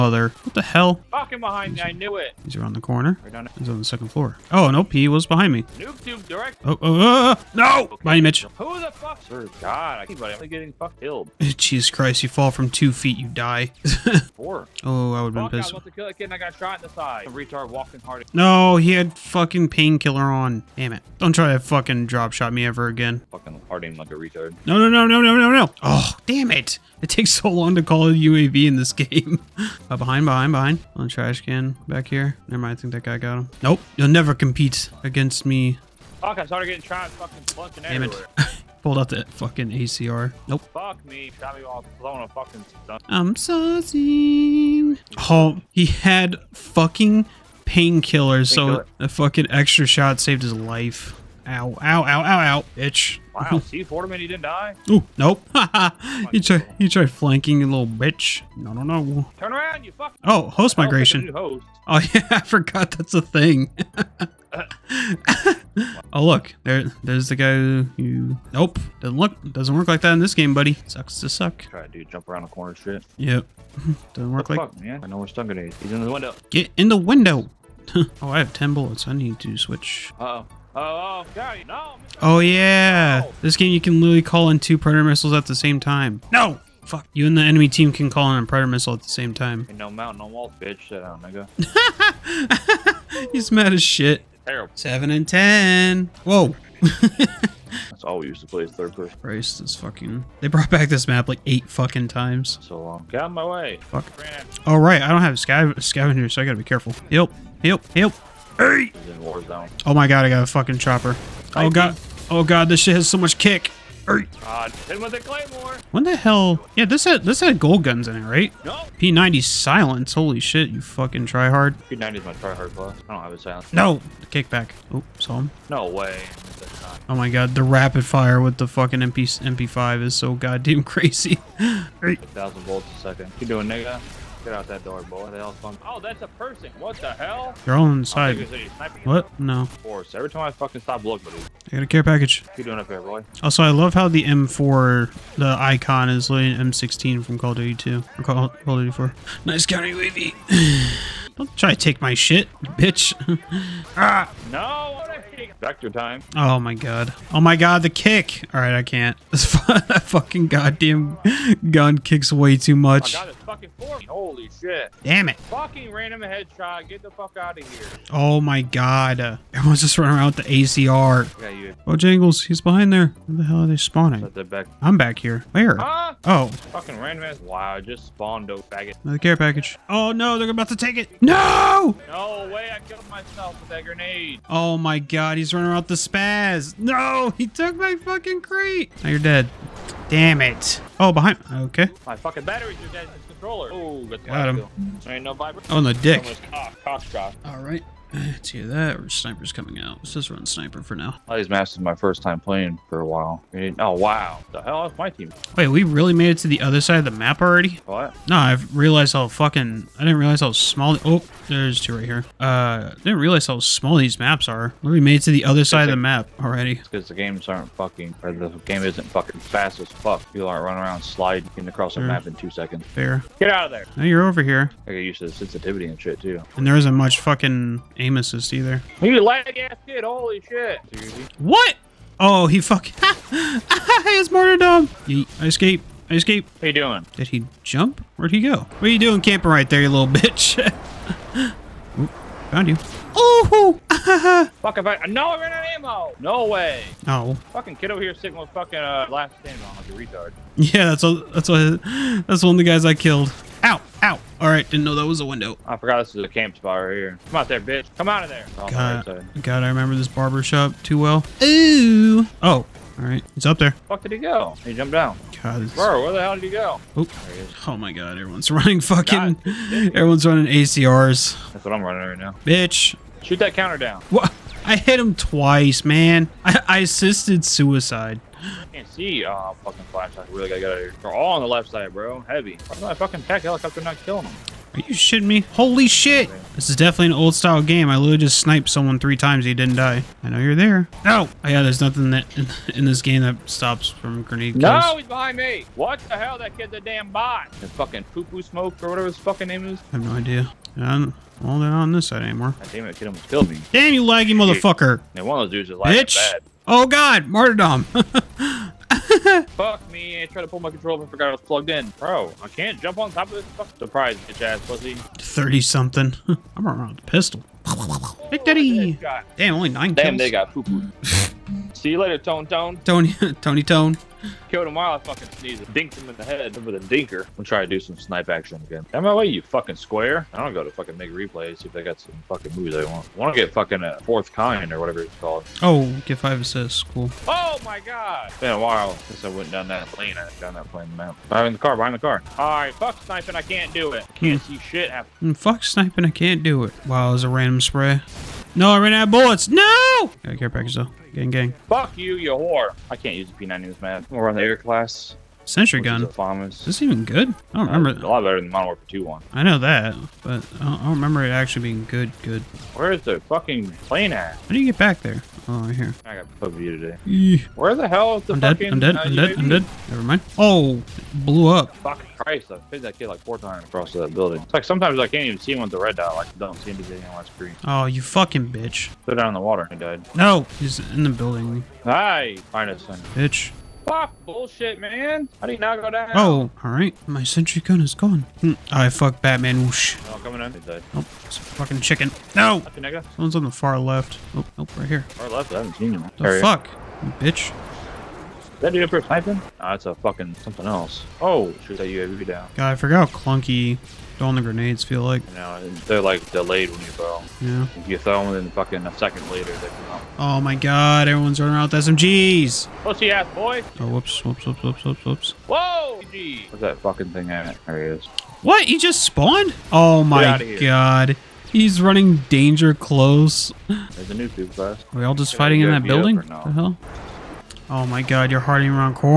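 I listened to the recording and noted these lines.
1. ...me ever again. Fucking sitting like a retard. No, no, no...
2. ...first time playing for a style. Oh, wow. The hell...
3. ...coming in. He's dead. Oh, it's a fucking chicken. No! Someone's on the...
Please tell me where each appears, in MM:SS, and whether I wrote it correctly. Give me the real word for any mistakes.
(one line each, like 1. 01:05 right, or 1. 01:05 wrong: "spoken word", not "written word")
1. 00:22 wrong: "harding", not "sitting"
2. 03:21 wrong: "while", not "style"
3. 06:30 right.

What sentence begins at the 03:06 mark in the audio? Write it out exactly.
No, he took my fucking crate.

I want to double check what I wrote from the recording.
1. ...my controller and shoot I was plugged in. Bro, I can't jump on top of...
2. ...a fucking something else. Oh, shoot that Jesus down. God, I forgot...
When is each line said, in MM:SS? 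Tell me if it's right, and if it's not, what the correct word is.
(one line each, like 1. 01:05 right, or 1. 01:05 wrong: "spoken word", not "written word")
1. 05:10 wrong: "forgot", not "shoot"
2. 06:39 wrong: "UAV", not "Jesus".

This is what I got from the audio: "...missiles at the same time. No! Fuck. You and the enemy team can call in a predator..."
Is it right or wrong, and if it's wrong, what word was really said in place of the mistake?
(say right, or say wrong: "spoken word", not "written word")
right.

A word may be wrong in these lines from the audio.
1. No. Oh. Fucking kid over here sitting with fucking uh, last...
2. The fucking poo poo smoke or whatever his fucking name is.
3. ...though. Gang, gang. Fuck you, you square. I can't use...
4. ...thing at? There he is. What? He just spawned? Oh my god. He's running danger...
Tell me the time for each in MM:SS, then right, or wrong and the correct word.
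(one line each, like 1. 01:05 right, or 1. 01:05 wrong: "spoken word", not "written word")
1. 04:07 right
2. 04:57 right
3. 05:50 wrong: "whore", not "square"
4. 06:57 right.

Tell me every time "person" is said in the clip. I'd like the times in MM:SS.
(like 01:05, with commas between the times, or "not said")
01:38, 02:16.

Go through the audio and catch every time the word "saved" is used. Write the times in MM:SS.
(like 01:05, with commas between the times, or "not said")
00:50.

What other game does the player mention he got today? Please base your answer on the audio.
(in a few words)
PUBG.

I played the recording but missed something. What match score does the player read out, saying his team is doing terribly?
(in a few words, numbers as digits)
7 and 10.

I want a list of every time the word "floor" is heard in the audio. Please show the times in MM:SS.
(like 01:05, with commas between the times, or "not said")
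00:04.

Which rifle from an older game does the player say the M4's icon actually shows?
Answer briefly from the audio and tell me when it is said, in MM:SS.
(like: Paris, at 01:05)
M16, at 02:26.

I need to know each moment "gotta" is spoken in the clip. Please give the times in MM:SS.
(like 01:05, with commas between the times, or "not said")
01:46, 04:40.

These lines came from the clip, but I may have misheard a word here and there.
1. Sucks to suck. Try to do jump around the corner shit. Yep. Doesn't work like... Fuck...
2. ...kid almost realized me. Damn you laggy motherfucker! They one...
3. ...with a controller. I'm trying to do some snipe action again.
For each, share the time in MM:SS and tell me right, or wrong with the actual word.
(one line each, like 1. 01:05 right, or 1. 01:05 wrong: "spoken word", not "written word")
1. 01:10 right
2. 05:02 wrong: "killed", not "realized"
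3. 05:26 wrong: "dinker", not "controller".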